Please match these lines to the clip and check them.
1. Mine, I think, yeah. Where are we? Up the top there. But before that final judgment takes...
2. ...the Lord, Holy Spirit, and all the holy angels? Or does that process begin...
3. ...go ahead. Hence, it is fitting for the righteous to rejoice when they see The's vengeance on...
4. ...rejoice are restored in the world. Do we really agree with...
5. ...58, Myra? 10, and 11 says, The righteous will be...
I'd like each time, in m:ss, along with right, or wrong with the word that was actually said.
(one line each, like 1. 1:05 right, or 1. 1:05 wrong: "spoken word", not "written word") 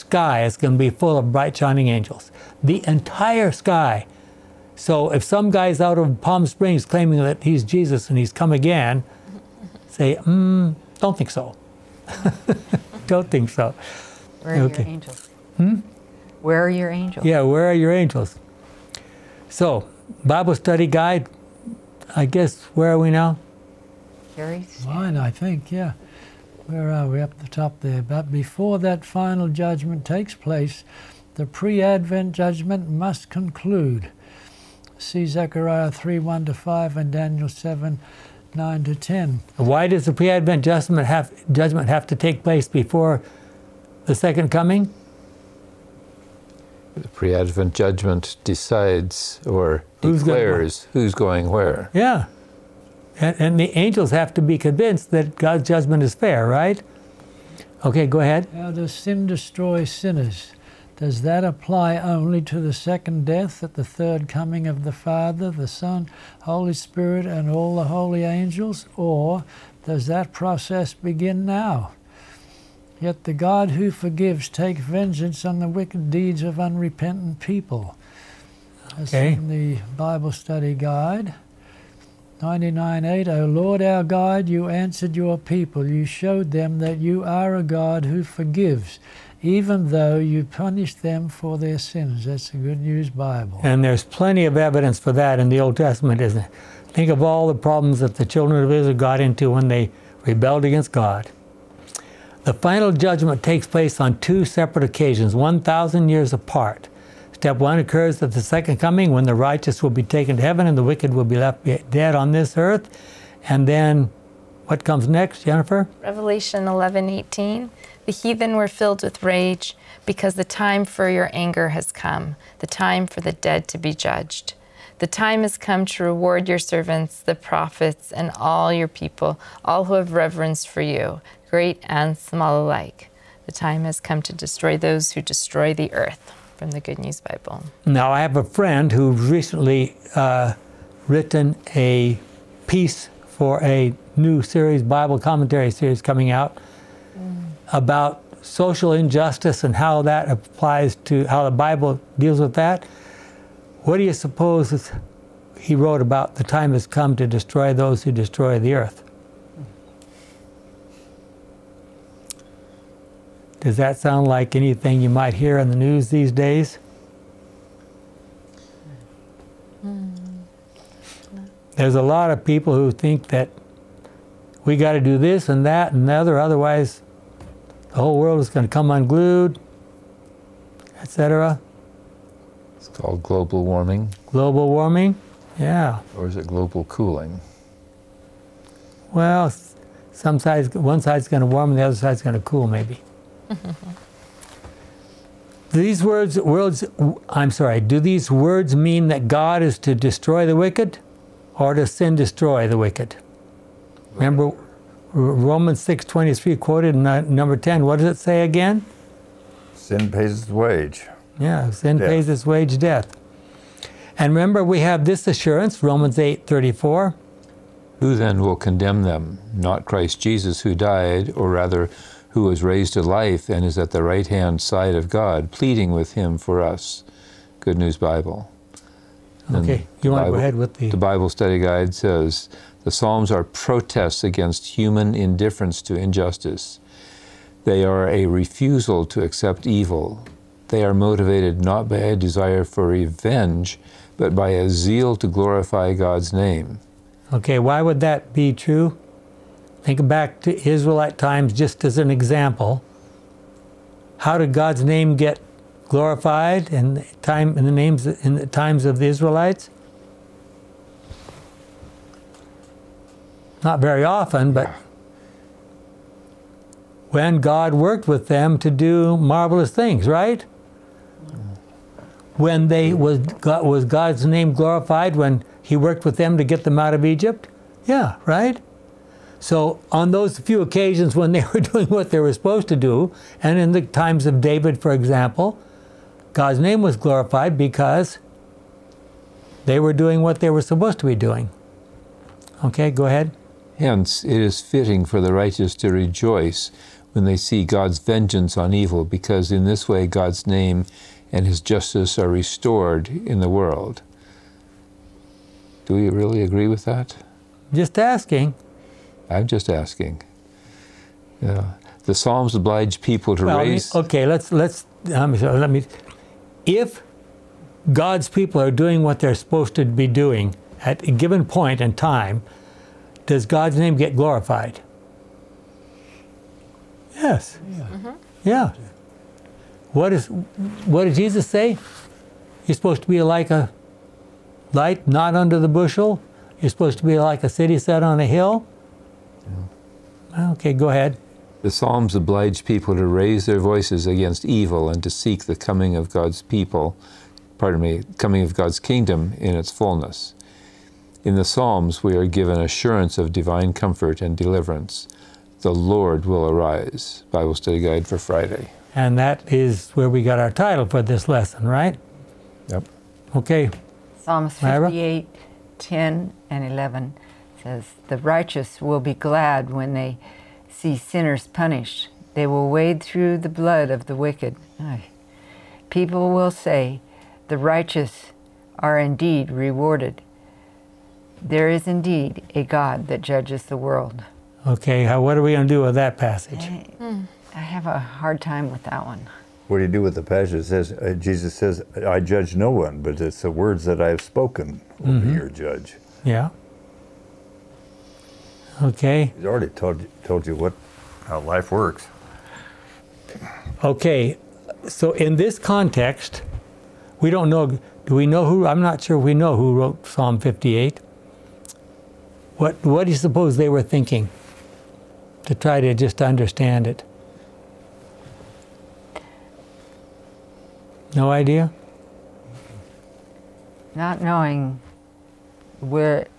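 1. 0:24 right
2. 1:05 wrong: "Son", not "Lord"
3. 4:52 wrong: "God", not "The"
4. 5:01 wrong: "justice", not "rejoice"
5. 6:04 right.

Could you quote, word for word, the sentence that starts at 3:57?
They are a refusal to accept evil.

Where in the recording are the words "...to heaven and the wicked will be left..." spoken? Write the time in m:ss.
1:50.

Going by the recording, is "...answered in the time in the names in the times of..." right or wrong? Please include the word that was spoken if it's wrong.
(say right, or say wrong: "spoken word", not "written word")
wrong: "glorified", not "answered".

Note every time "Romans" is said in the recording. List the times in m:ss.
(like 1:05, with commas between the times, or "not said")
3:25, 3:35.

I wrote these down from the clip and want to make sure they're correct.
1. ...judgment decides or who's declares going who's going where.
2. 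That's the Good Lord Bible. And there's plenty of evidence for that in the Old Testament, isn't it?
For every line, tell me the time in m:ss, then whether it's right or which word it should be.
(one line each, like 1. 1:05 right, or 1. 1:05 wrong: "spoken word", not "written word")
1. 0:47 right
2. 1:32 wrong: "News", not "Lord".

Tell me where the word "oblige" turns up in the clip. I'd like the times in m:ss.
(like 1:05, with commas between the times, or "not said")
5:12, 5:42.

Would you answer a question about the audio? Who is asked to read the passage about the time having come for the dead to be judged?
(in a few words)
Jennifer.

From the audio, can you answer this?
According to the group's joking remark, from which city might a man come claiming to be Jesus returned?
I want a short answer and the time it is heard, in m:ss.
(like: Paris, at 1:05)
Palm Springs, at 0:06.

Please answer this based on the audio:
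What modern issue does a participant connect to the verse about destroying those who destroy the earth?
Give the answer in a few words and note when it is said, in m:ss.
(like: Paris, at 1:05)
Global warming, at 3:02.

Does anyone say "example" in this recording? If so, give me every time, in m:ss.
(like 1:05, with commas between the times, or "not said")
4:12, 4:44.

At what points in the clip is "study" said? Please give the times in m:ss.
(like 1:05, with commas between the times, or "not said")
0:20, 1:20, 3:51, 5:57.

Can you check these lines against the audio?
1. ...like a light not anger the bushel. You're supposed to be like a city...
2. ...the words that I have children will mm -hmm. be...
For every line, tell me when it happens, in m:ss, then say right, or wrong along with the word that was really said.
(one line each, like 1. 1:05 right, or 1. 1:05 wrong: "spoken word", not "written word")
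1. 5:33 wrong: "under", not "anger"
2. 6:33 wrong: "spoken", not "children".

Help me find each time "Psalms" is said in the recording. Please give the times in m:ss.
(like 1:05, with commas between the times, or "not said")
3:52, 5:12, 5:41, 5:51, 6:04, 6:50.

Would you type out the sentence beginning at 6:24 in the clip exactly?
Okay, how, what are we going to do with that passage?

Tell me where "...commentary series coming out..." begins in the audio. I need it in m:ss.
2:25.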